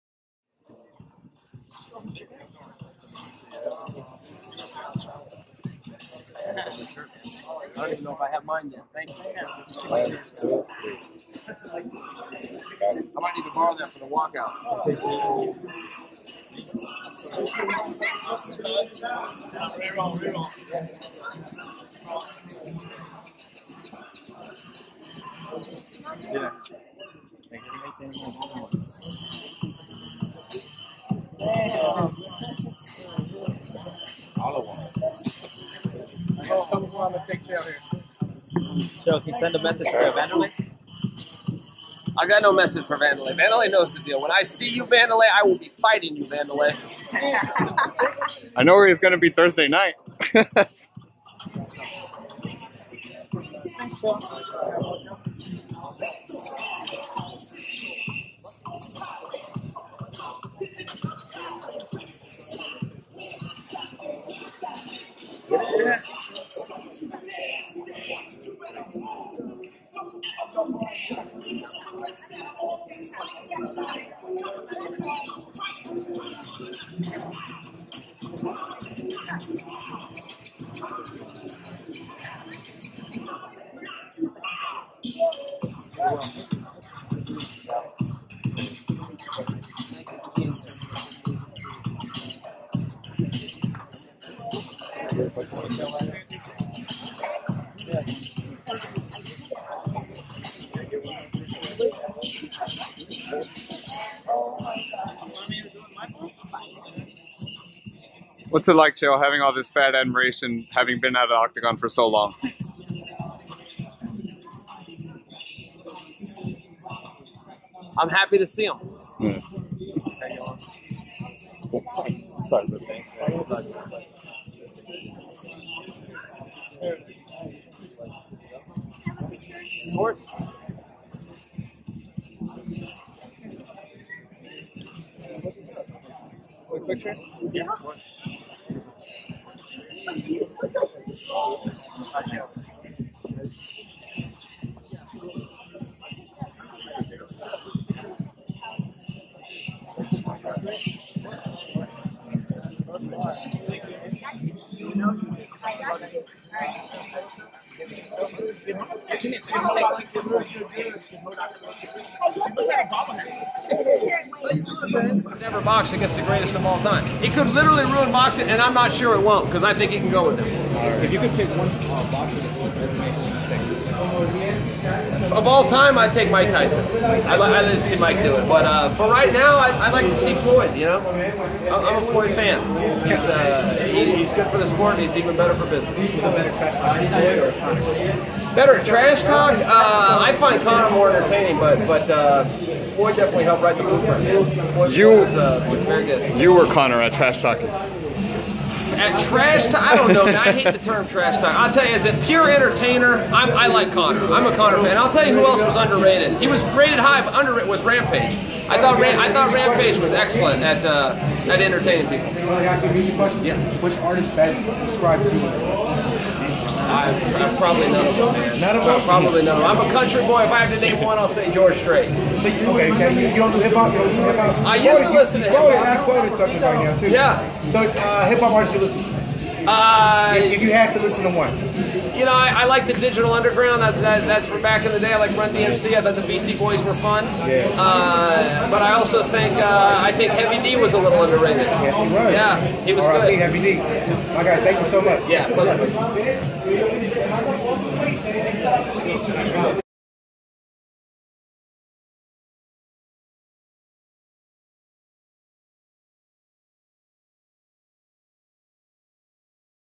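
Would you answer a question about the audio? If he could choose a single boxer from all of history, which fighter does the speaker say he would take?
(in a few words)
Mike Tyson.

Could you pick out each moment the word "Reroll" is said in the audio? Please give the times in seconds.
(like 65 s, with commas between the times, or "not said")
17 s.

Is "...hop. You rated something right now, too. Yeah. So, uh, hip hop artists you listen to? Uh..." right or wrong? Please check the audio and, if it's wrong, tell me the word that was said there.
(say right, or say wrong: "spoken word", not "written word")
wrong: "quoted", not "rated".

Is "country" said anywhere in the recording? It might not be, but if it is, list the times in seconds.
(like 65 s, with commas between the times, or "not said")
219 s.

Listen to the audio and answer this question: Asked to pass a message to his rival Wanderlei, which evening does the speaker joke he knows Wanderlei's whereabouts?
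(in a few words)
Thursday night.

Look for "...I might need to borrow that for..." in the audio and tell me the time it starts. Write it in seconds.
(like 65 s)
9 s.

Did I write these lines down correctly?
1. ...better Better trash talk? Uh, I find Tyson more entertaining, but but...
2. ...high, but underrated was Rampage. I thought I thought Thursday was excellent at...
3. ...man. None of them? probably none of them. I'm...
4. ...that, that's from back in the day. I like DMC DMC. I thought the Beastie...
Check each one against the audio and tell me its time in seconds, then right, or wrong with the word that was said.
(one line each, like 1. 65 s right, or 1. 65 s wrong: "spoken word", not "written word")
1. 186 s wrong: "Conor", not "Tyson"
2. 206 s wrong: "Rampage", not "Thursday"
3. 218 s right
4. 233 s wrong: "Run", not "DMC".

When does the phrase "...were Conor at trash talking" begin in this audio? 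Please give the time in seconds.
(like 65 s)
196 s.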